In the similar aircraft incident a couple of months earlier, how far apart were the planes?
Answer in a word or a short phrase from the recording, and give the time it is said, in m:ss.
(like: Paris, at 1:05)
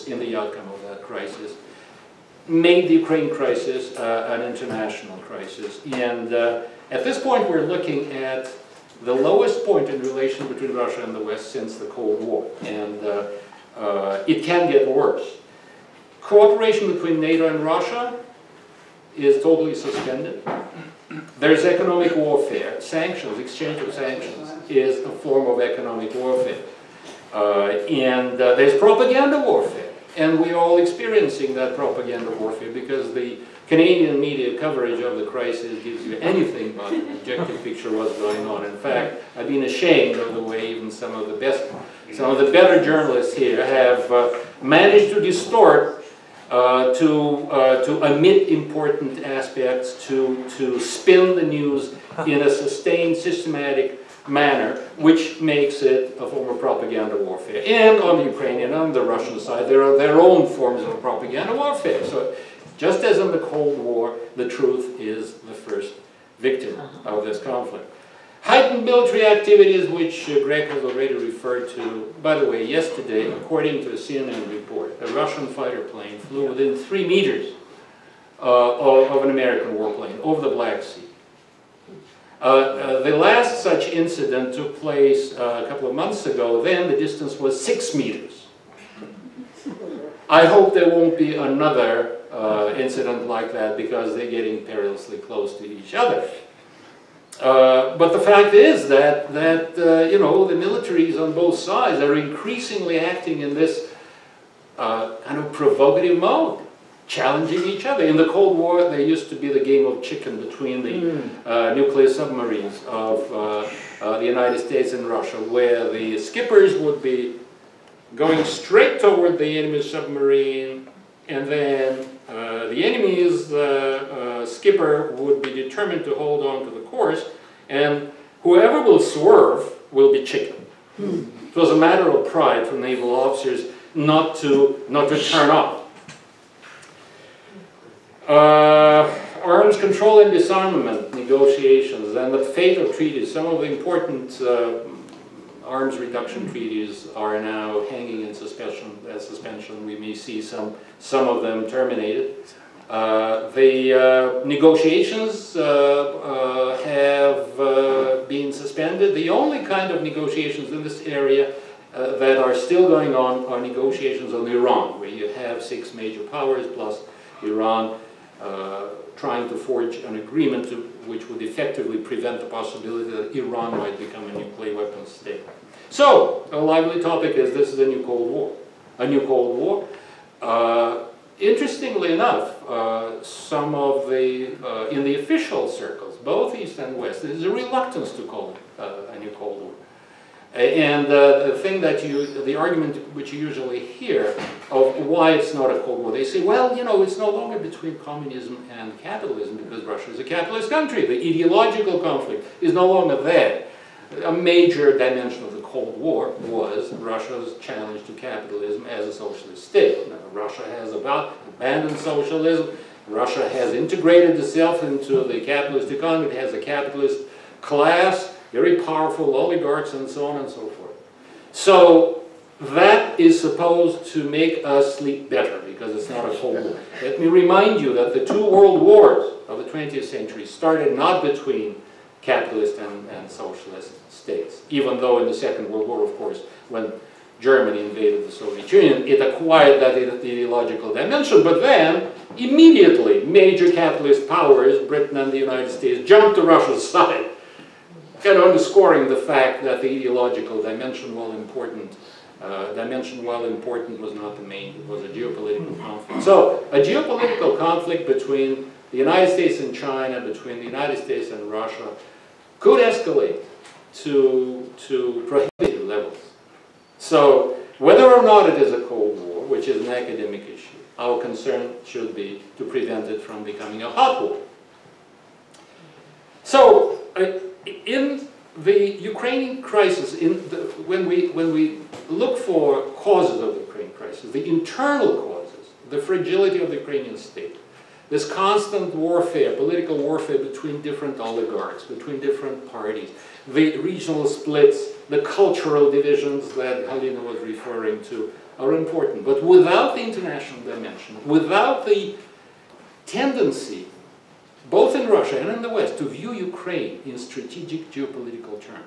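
6 meters, at 1:27.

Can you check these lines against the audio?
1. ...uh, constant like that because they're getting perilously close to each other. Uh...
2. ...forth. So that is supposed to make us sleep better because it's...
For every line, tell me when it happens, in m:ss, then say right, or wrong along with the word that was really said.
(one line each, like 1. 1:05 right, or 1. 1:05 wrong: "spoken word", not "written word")
1. 1:32 wrong: "incident", not "constant"
2. 3:40 right.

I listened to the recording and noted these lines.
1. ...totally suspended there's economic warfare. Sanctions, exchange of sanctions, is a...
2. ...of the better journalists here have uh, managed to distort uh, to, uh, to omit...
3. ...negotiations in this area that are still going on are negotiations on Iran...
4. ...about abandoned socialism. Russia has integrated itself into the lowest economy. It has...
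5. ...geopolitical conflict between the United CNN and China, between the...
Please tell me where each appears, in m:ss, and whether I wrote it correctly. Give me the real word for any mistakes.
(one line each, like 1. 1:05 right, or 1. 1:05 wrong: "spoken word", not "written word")
1. 0:19 right
2. 0:42 right
3. 2:40 right
4. 3:30 wrong: "capitalist", not "lowest"
5. 4:16 wrong: "States", not "CNN".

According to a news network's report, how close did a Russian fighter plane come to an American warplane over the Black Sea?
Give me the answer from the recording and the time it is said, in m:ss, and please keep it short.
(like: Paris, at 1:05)
3 meters, at 1:16.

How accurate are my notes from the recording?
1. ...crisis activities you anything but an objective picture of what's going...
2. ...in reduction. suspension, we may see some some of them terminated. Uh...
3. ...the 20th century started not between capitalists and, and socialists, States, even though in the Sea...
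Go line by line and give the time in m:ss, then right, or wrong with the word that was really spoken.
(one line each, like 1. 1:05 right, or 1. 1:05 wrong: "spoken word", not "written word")
1. 0:35 wrong: "gives", not "activities"
2. 2:28 wrong: "suspension", not "reduction"
3. 3:49 wrong: "Second", not "Sea".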